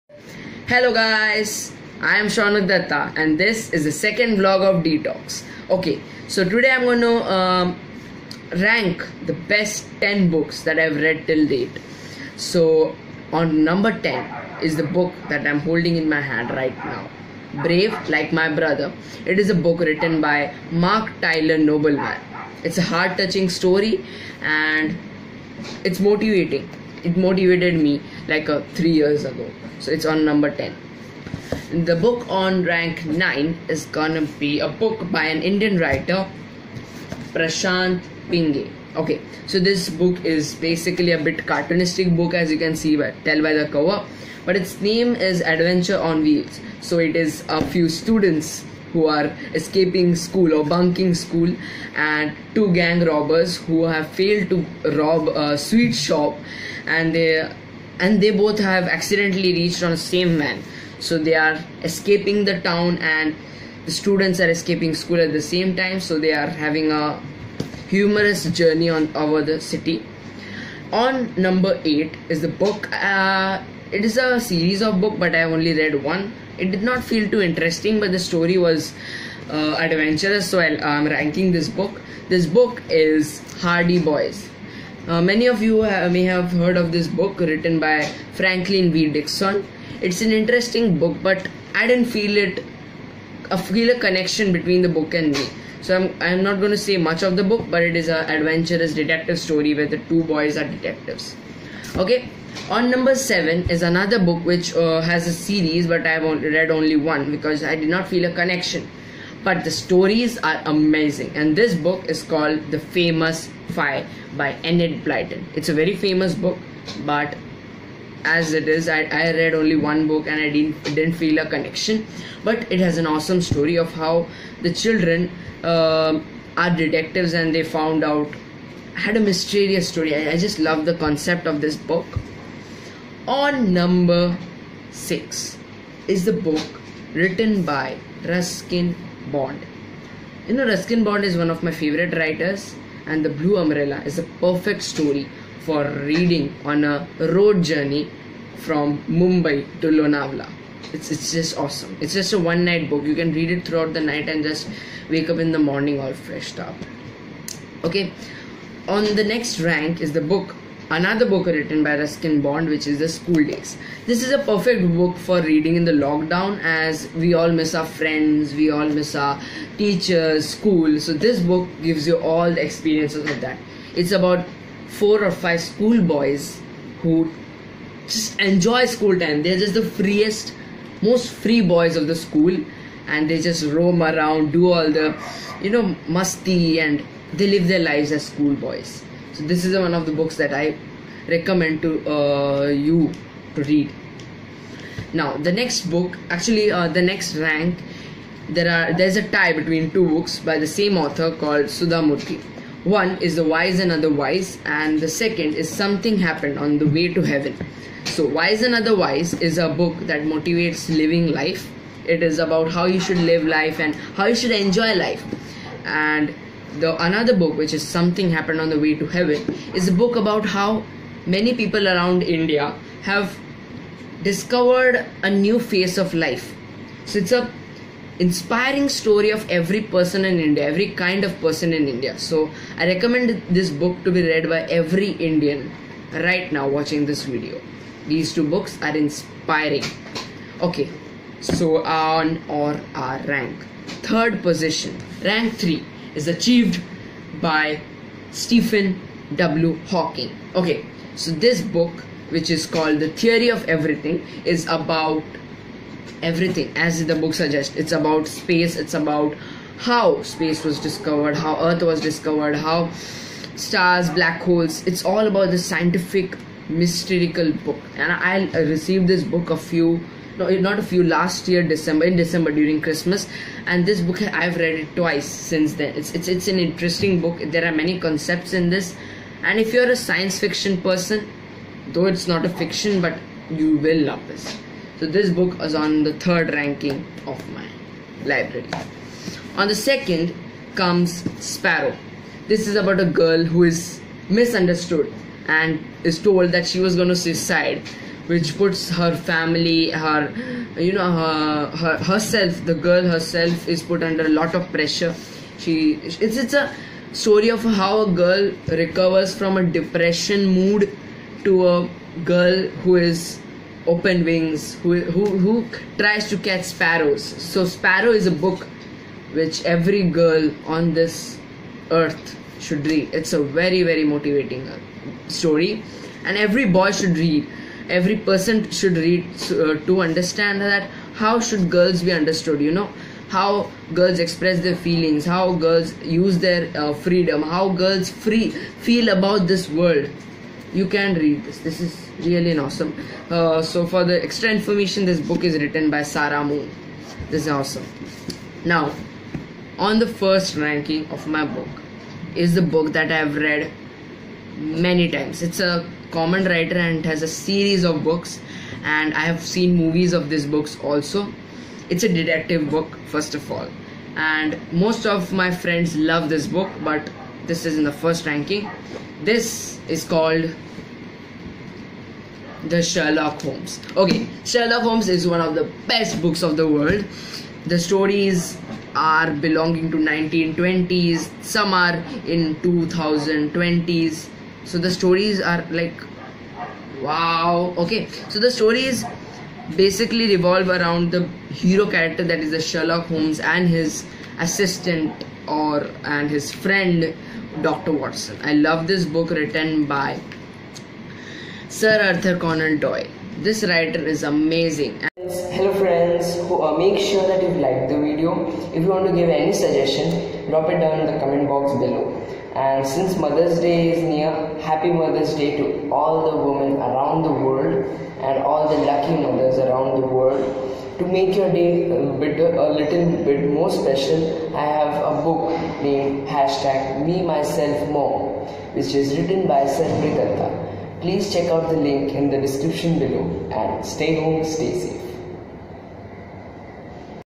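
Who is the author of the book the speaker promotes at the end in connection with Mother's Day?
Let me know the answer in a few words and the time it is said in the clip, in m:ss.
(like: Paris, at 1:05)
Sarvi, at 7:09.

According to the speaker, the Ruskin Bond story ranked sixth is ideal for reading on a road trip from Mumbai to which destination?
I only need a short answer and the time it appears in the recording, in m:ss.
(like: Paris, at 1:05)
Lonavala, at 2:29.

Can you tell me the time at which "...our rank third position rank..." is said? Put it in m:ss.
4:02.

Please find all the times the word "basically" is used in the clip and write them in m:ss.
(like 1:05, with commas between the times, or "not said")
0:40, 6:29.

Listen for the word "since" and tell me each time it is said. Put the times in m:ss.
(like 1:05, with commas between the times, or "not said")
4:35, 6:52.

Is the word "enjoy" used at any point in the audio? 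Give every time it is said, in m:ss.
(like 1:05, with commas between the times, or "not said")
2:58, 3:34.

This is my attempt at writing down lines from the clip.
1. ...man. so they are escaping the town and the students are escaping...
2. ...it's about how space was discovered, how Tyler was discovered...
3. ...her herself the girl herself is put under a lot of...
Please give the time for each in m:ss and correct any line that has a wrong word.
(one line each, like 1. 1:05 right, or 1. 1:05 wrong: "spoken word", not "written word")
1. 1:00 right
2. 4:18 wrong: "Earth", not "Tyler"
3. 5:01 right.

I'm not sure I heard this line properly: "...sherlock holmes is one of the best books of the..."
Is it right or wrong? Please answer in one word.
right.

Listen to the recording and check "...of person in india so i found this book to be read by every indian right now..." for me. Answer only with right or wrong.
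wrong.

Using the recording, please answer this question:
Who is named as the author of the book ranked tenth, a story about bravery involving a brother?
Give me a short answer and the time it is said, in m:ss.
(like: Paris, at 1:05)
Mark Tyler Nobleman, at 0:20.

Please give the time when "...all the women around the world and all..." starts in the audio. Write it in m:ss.
6:55.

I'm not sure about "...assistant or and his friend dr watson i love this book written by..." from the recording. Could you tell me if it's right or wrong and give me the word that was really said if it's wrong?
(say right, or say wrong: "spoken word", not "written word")
right.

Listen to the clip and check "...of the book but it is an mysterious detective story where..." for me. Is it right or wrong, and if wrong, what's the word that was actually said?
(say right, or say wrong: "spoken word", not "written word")
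wrong: "adventurous", not "mysterious".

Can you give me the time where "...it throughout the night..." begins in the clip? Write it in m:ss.
2:33.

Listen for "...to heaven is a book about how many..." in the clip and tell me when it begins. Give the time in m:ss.
3:38.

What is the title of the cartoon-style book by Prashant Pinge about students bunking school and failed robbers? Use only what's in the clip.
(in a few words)
Adventure on Wheels.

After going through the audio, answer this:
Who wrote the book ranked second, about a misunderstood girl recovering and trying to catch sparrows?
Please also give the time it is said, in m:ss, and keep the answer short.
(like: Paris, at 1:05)
Sarah Moon, at 5:46.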